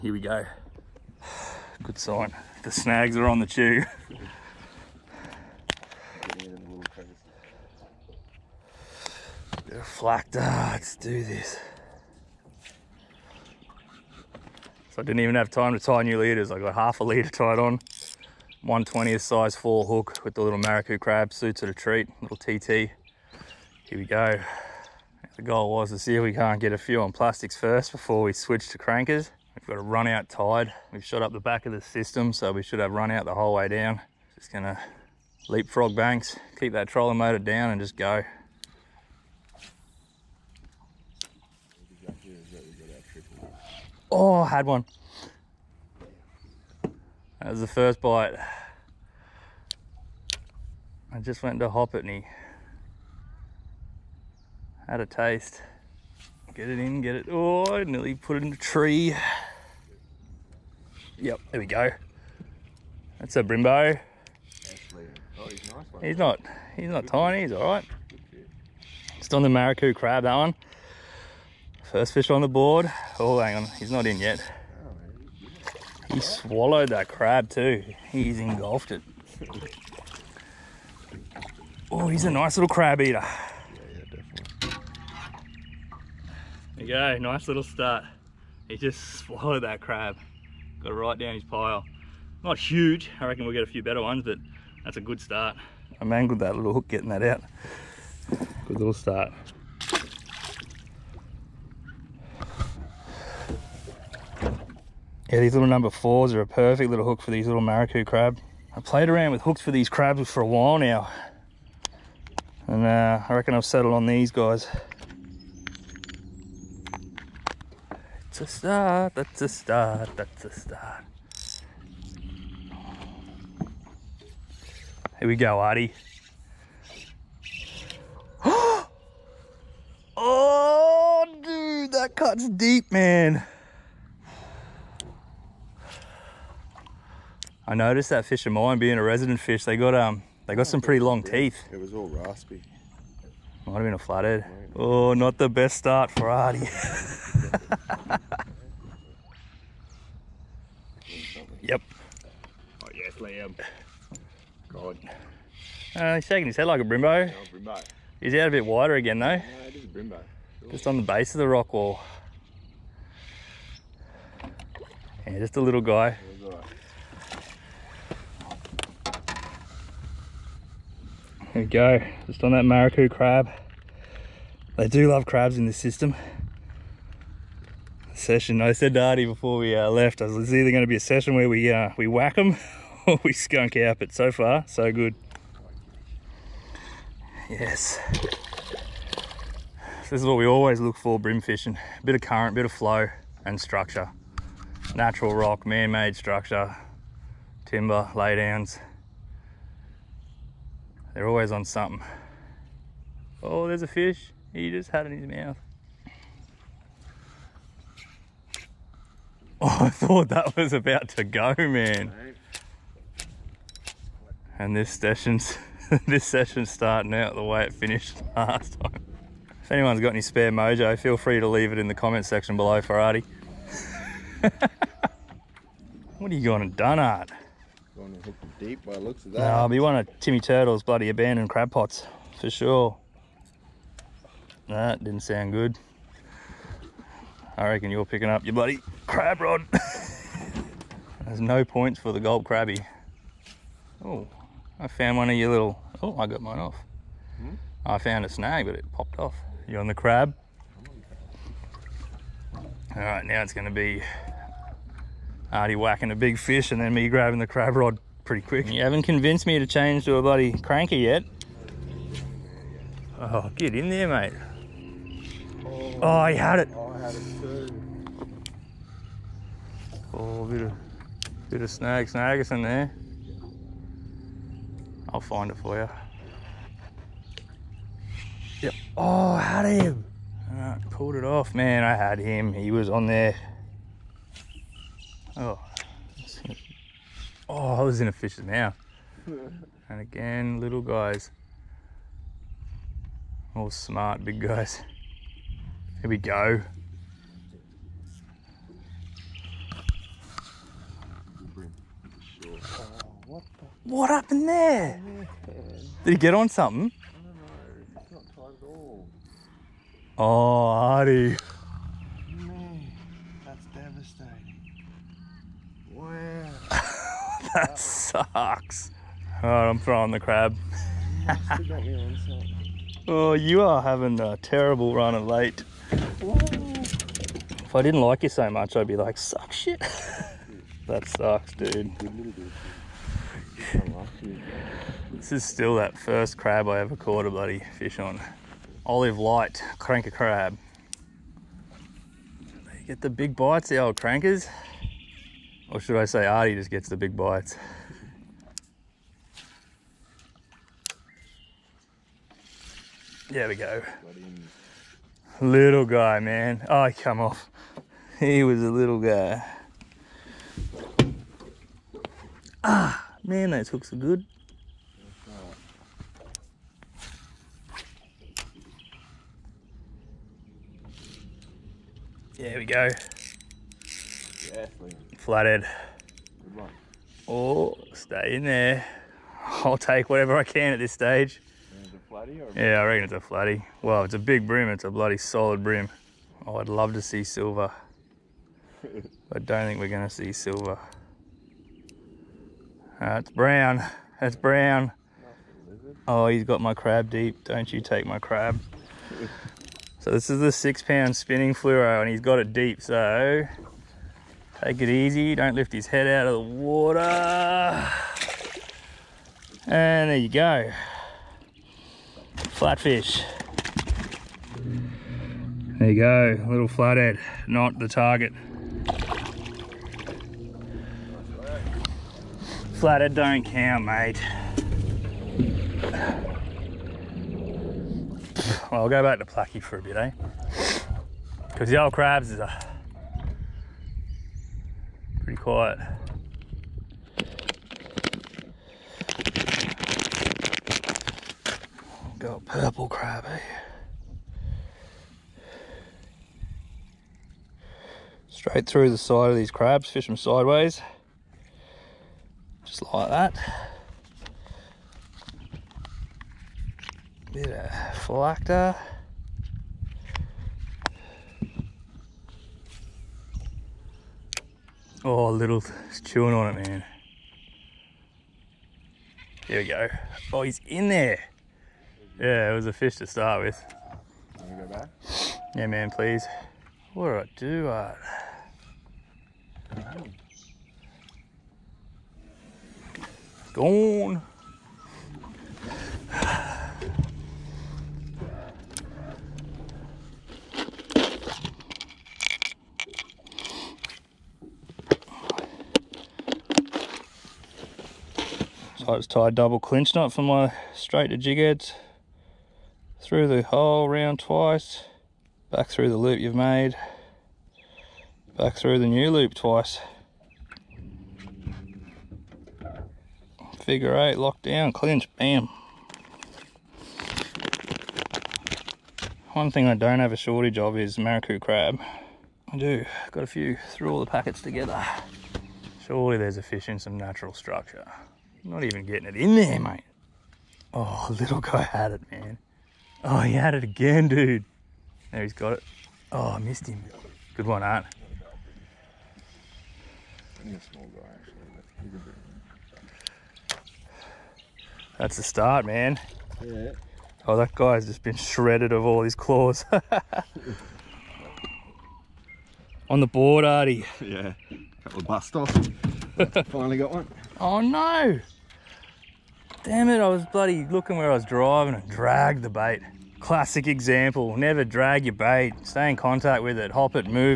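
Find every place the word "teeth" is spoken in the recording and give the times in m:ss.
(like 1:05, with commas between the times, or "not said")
2:21.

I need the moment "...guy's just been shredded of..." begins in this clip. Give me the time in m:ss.
9:07.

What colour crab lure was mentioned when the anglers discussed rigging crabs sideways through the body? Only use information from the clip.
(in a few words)
purple.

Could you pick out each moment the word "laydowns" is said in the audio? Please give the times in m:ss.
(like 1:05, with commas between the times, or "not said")
3:18.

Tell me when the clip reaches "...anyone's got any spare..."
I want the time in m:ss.
3:39.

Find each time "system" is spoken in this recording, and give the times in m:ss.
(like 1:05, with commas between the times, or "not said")
0:31, 2:55.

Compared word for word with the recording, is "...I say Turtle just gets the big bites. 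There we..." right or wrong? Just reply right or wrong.
wrong.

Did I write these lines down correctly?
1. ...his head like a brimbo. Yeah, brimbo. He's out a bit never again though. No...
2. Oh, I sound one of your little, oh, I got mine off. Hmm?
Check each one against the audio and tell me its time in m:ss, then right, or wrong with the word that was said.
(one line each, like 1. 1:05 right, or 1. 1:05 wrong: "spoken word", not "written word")
1. 2:36 wrong: "wider", not "never"
2. 4:04 wrong: "found", not "sound".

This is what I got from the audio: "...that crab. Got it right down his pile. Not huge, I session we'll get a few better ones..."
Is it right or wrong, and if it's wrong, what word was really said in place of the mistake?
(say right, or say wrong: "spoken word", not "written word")
wrong: "reckon", not "session".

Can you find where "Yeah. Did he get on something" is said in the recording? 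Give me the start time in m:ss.
5:05.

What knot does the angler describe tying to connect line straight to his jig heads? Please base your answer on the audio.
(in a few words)
double clinch knot.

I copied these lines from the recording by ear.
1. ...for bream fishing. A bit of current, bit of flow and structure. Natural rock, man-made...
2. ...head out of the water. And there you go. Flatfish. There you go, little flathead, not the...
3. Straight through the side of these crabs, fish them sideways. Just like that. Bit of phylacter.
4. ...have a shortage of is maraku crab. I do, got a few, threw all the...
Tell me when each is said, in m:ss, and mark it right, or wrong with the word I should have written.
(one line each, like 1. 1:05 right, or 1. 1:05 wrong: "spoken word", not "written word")
1. 3:10 right
2. 6:45 right
3. 7:28 right
4. 8:40 right.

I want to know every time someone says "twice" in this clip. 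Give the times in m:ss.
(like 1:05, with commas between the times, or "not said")
8:24, 8:29.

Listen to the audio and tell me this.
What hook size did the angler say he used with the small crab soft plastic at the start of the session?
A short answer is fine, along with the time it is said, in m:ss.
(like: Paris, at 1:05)
size 4, at 0:19.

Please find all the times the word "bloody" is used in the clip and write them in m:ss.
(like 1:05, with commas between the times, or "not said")
3:50, 3:58, 4:20, 5:37, 6:24, 9:20.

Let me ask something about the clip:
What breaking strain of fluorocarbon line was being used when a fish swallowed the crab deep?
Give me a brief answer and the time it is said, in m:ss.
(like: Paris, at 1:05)
6 pound, at 6:40.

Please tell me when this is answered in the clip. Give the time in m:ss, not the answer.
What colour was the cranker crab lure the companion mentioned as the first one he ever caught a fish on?
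5:38.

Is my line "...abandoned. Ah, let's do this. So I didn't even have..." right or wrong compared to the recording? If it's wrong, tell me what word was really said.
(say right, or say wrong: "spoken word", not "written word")
wrong: "flacked", not "abandoned".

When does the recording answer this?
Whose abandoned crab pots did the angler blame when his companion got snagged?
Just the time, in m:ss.
3:50.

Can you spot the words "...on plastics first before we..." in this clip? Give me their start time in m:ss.
0:27.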